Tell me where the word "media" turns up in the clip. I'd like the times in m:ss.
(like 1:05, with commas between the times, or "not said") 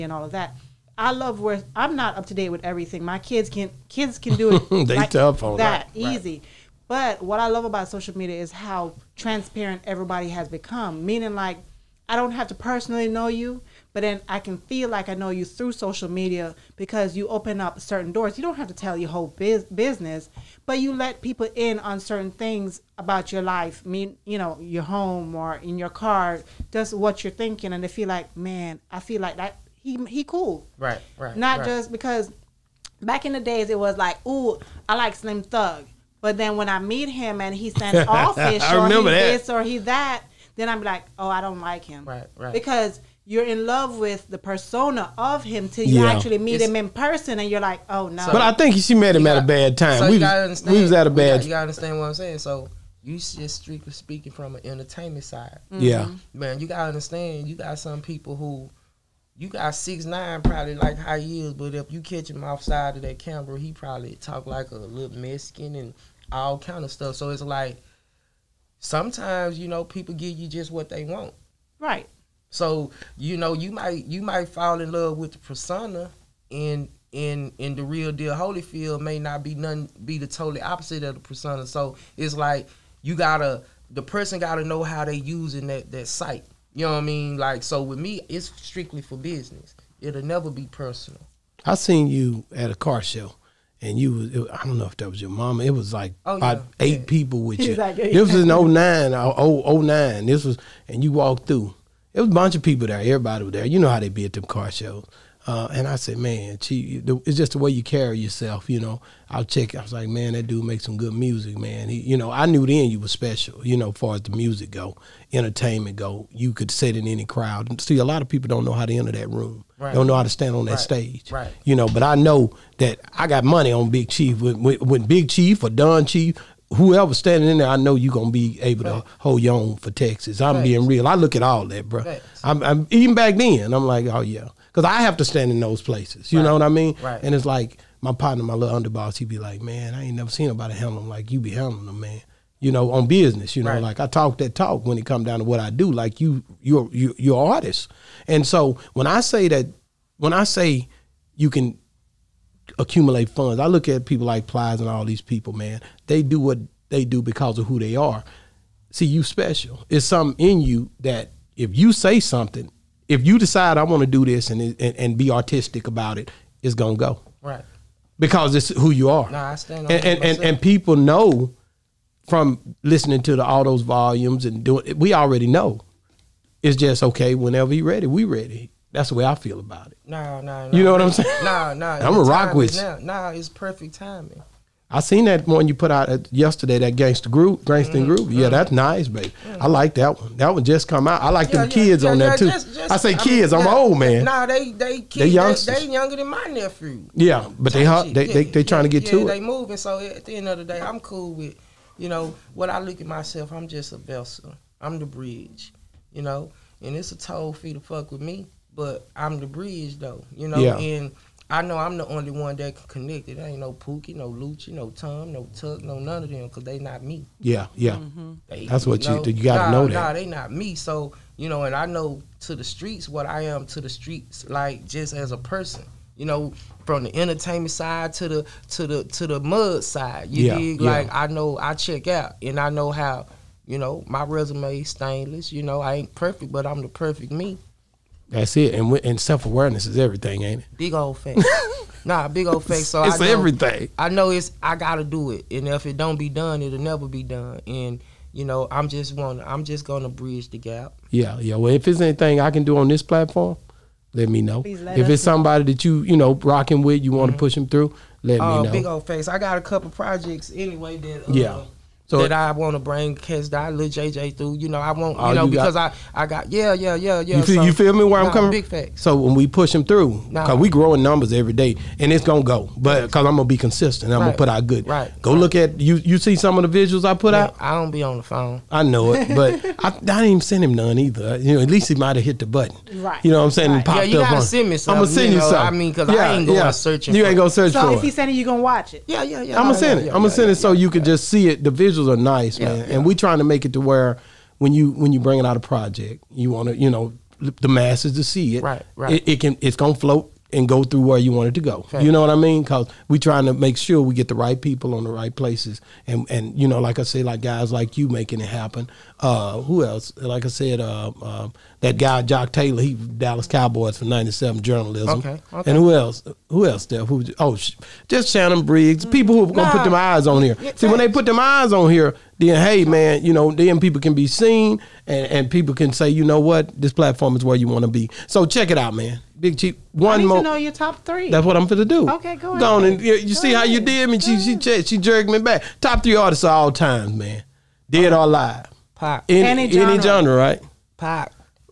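0:08, 0:16.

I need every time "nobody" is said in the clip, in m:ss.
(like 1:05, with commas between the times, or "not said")
2:20.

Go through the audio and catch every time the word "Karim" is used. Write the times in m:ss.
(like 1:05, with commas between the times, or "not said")
not said.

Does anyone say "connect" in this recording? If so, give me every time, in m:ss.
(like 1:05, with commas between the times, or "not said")
3:32.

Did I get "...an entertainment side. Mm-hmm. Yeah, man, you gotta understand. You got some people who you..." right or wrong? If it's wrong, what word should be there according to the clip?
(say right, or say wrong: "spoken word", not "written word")
right.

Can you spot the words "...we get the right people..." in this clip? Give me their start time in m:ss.
5:04.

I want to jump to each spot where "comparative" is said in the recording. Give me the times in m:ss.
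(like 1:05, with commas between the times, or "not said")
not said.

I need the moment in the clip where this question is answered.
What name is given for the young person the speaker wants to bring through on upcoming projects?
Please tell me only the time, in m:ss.
4:23.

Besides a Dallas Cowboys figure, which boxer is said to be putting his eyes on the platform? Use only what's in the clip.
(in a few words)
Shannon Briggs.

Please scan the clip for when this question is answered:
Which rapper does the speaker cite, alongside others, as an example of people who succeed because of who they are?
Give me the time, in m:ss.
2:34.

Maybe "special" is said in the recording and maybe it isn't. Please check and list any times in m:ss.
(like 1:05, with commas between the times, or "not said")
1:53, 2:39.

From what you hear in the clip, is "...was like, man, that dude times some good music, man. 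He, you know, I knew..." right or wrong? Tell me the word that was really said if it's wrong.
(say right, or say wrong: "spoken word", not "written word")
wrong: "makes", not "times".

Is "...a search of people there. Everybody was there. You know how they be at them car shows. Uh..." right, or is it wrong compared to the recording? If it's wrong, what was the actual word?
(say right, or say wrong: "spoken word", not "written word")
wrong: "bunch", not "search".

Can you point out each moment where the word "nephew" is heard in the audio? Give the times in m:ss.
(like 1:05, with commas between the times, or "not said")
3:16.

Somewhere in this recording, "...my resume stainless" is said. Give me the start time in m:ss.
3:54.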